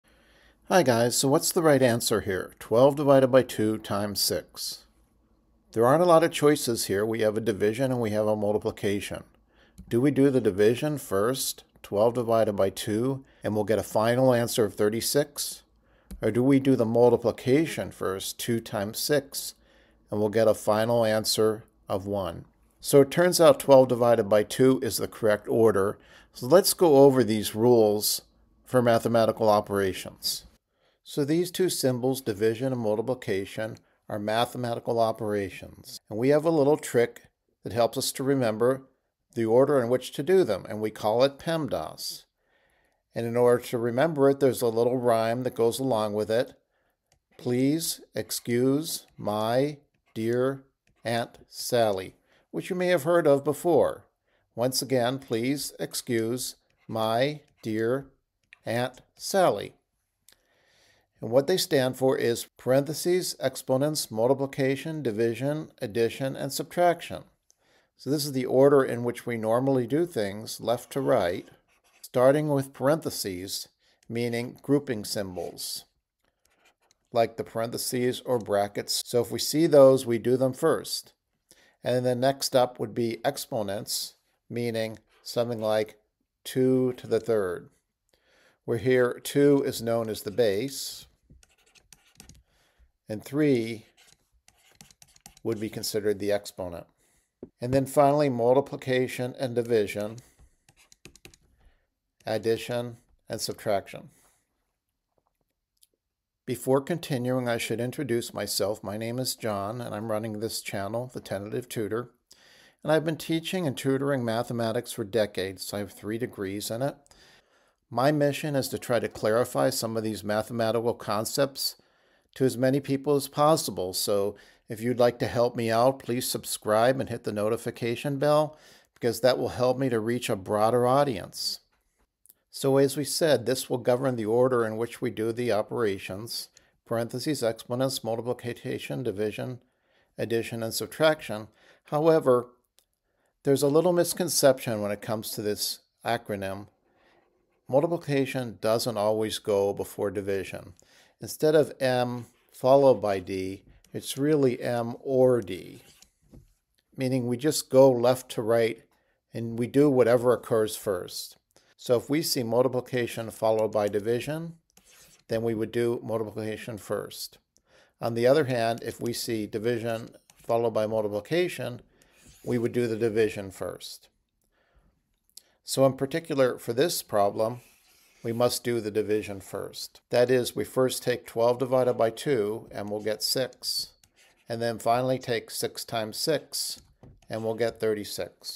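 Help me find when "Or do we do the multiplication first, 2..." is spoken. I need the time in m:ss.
0:16.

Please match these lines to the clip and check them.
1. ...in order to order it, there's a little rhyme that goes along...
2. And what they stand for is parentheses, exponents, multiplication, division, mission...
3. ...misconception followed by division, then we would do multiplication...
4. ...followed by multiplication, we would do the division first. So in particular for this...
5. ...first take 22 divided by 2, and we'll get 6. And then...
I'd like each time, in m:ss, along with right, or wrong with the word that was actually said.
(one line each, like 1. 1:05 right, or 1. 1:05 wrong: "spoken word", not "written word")
1. 0:43 wrong: "remember", not "order"
2. 1:01 wrong: "addition", not "mission"
3. 2:42 wrong: "multiplication", not "misconception"
4. 2:50 right
5. 3:00 wrong: "12", not "22".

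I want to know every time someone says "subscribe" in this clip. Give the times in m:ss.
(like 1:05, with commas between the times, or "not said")
2:06.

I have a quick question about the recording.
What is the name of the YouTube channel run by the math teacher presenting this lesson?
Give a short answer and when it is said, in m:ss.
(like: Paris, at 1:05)
The Tentative Tutor, at 1:51.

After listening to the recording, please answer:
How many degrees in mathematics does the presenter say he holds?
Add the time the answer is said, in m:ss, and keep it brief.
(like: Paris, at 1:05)
3, at 1:55.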